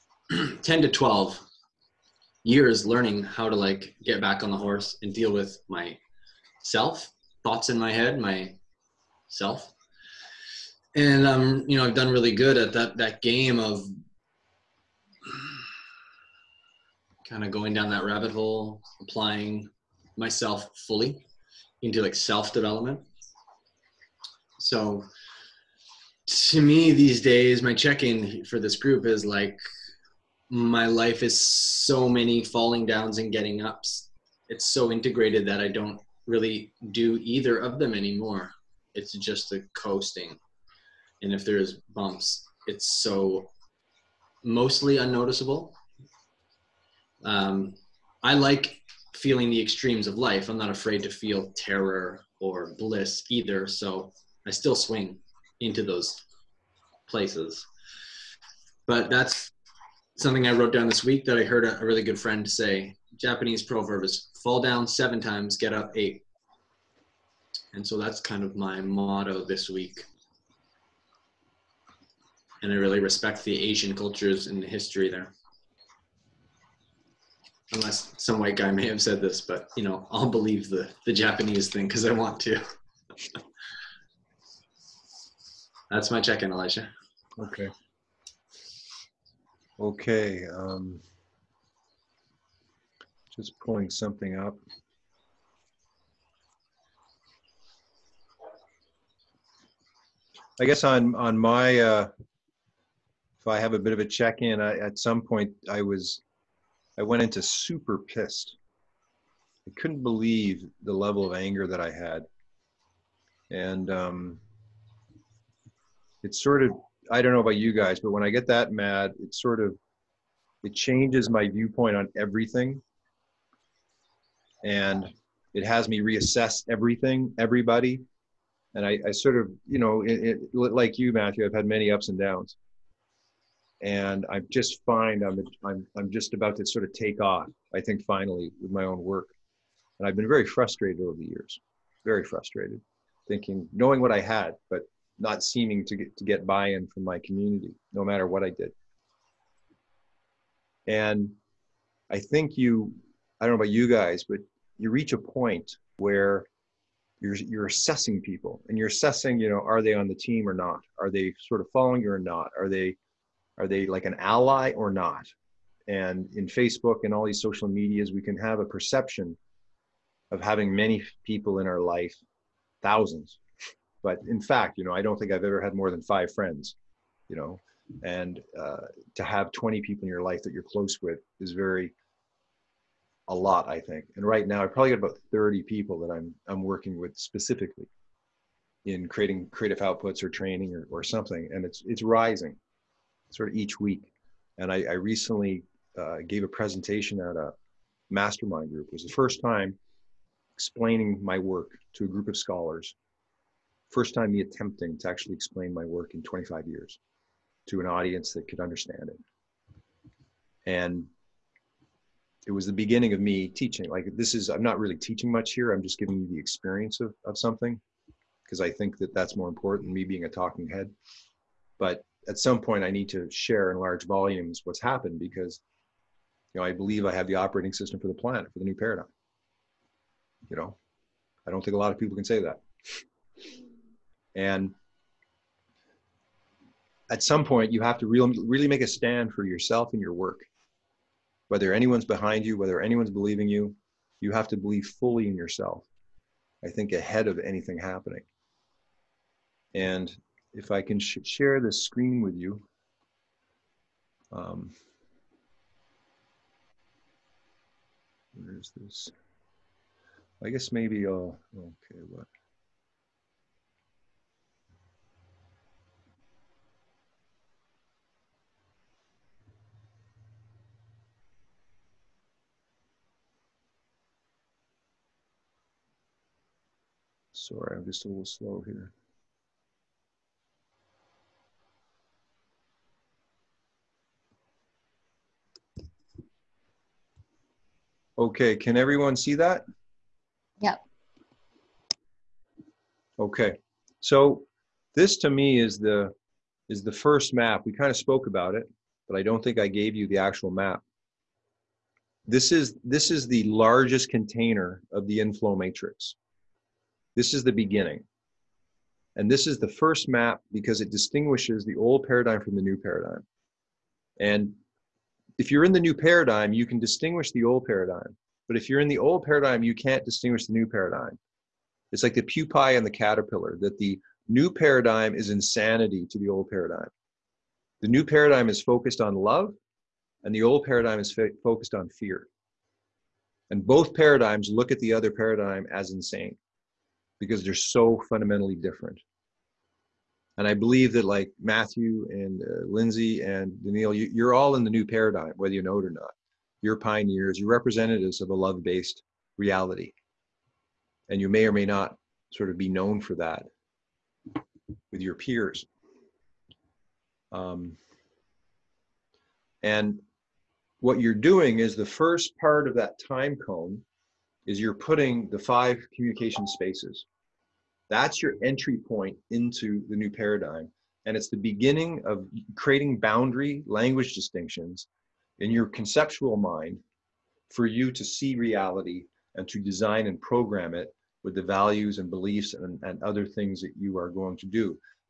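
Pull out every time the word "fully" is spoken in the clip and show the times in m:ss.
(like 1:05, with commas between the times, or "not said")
0:20, 4:04.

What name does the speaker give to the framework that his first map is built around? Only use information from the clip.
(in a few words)
inflow matrix.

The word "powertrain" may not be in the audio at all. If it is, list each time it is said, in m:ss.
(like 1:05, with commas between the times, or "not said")
not said.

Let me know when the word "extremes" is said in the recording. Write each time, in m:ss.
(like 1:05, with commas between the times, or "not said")
0:49.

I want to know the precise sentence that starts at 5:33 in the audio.
And both paradigms look at the other paradigm as insane because they're so fundamentally different.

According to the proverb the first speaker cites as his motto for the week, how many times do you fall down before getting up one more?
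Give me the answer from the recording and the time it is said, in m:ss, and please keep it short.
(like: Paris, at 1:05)
7, at 1:04.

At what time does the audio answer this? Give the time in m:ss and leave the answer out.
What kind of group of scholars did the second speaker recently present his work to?
3:18.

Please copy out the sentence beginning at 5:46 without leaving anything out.
You're pioneers, you're representatives of a love based reality.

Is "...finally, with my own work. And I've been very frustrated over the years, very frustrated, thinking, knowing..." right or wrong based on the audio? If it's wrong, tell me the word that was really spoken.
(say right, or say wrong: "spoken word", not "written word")
right.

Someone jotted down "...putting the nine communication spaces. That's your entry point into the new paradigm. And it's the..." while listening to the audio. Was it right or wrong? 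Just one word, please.
wrong.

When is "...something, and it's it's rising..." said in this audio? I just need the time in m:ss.
3:11.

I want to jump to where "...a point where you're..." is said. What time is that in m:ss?
2:35.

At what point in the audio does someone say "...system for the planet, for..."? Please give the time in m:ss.
3:47.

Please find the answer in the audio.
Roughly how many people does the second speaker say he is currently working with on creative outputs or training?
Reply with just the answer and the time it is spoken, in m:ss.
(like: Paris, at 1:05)
30, at 3:05.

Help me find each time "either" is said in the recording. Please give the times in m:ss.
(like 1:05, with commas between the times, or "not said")
0:37, 0:53.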